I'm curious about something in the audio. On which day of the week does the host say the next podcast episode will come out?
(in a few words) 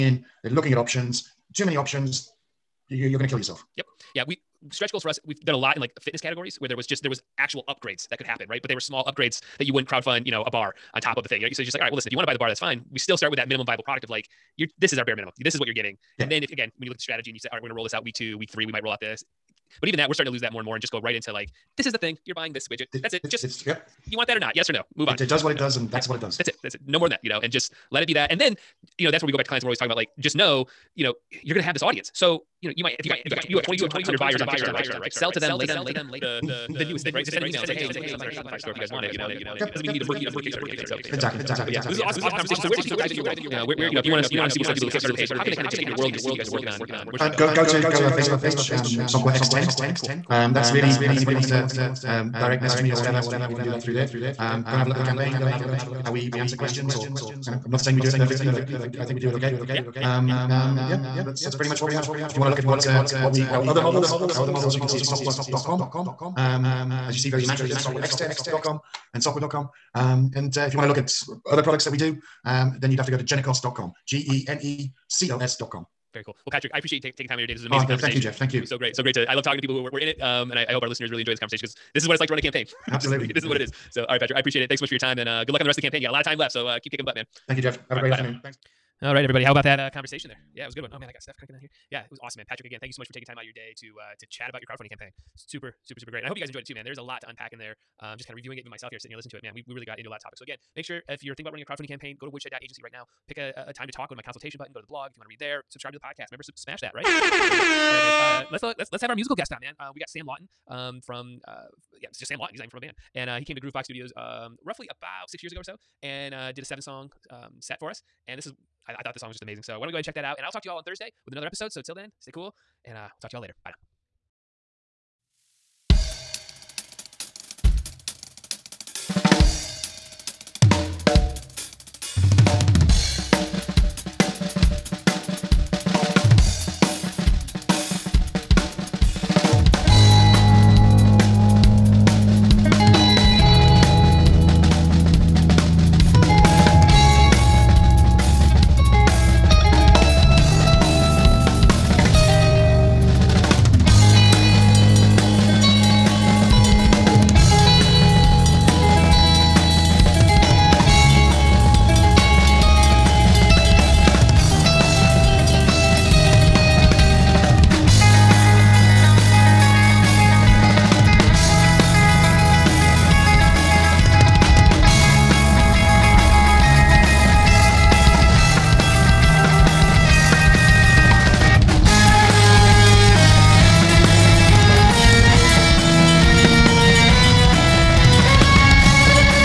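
Thursday.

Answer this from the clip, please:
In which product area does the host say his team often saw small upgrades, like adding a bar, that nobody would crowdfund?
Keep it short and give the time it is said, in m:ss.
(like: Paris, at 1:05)
Fitness, at 0:05.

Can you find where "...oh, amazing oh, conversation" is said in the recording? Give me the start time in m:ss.
1:17.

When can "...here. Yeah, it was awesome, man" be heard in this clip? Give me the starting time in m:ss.
1:31.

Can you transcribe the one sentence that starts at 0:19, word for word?
But even that, we're starting to lose that more and more and just go right into like, this is the thing.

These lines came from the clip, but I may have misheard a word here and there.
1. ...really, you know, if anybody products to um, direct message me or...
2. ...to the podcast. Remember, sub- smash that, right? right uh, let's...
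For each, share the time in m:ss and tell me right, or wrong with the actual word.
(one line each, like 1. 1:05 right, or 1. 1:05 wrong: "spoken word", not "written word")
1. 0:50 wrong: "wants", not "products"
2. 1:45 right.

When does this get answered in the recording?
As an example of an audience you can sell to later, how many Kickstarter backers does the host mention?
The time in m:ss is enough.
0:33.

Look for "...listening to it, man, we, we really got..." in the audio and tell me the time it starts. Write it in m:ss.
1:39.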